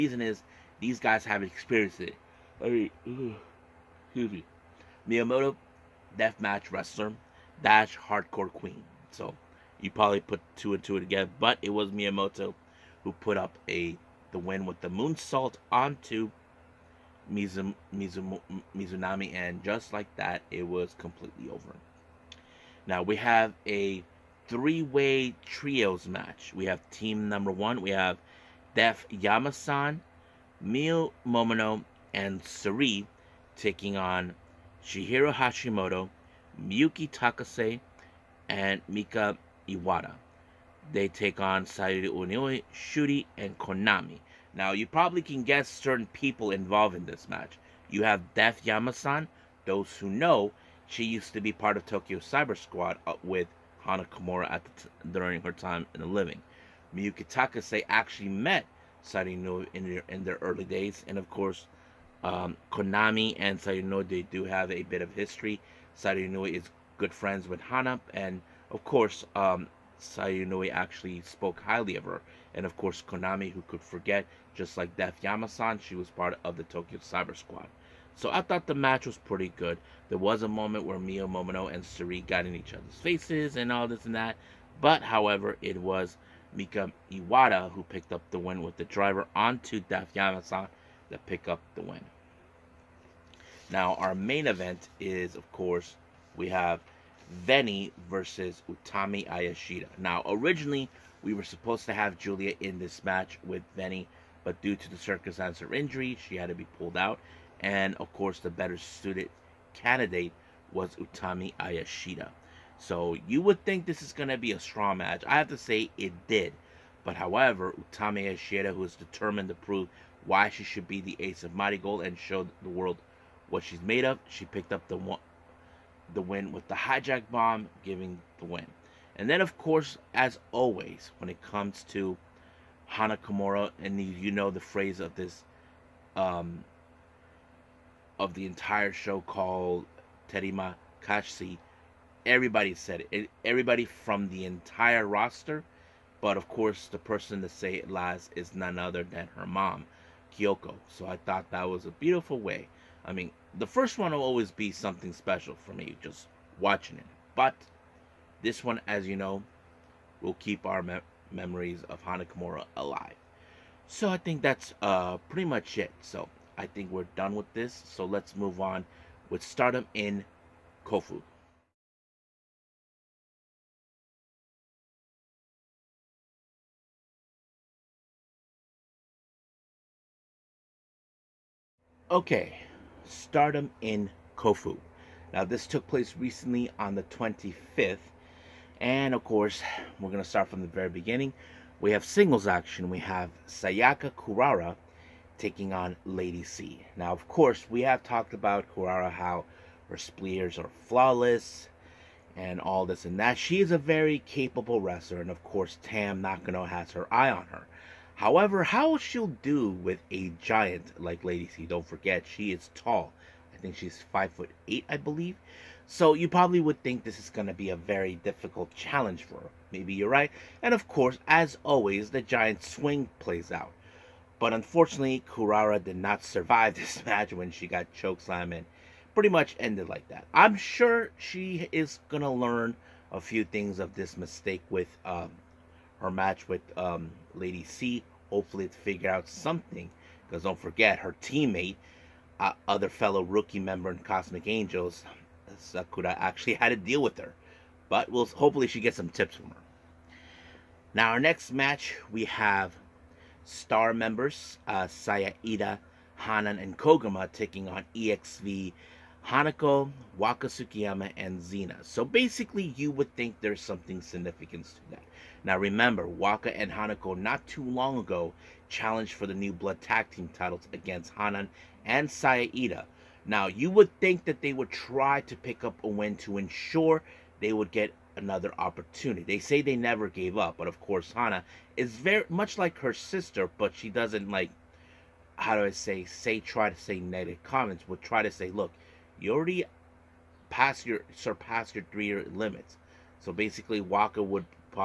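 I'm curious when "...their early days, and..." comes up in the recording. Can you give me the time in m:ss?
1:00.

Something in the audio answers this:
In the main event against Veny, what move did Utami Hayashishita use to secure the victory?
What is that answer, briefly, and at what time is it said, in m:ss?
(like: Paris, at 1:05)
hijack bomb, at 2:06.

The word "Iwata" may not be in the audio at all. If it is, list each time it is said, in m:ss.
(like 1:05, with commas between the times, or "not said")
0:39, 1:27.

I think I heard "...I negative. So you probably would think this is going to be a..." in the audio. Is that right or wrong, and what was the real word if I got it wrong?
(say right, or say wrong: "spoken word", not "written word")
wrong: "believe", not "negative".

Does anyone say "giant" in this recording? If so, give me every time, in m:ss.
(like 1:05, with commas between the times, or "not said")
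3:30, 3:42.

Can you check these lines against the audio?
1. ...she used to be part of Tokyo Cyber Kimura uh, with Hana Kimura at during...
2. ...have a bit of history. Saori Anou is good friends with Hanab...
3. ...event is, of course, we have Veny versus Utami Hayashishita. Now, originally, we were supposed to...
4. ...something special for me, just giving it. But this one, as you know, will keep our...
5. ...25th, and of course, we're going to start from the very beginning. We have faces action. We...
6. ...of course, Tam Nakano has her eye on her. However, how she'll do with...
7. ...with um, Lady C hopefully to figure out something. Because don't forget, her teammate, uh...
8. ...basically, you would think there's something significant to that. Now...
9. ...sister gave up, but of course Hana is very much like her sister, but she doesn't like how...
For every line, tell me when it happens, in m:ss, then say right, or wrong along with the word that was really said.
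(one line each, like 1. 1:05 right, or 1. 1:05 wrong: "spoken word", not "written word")
1. 0:50 wrong: "Squad", not "Kimura"
2. 1:04 right
3. 1:34 right
4. 2:34 wrong: "watching", not "giving"
5. 3:07 wrong: "singles", not "faces"
6. 3:25 right
7. 3:56 right
8. 4:22 right
9. 4:39 wrong: "never", not "sister".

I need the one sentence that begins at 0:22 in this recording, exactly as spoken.
Now we have a three-way trios match.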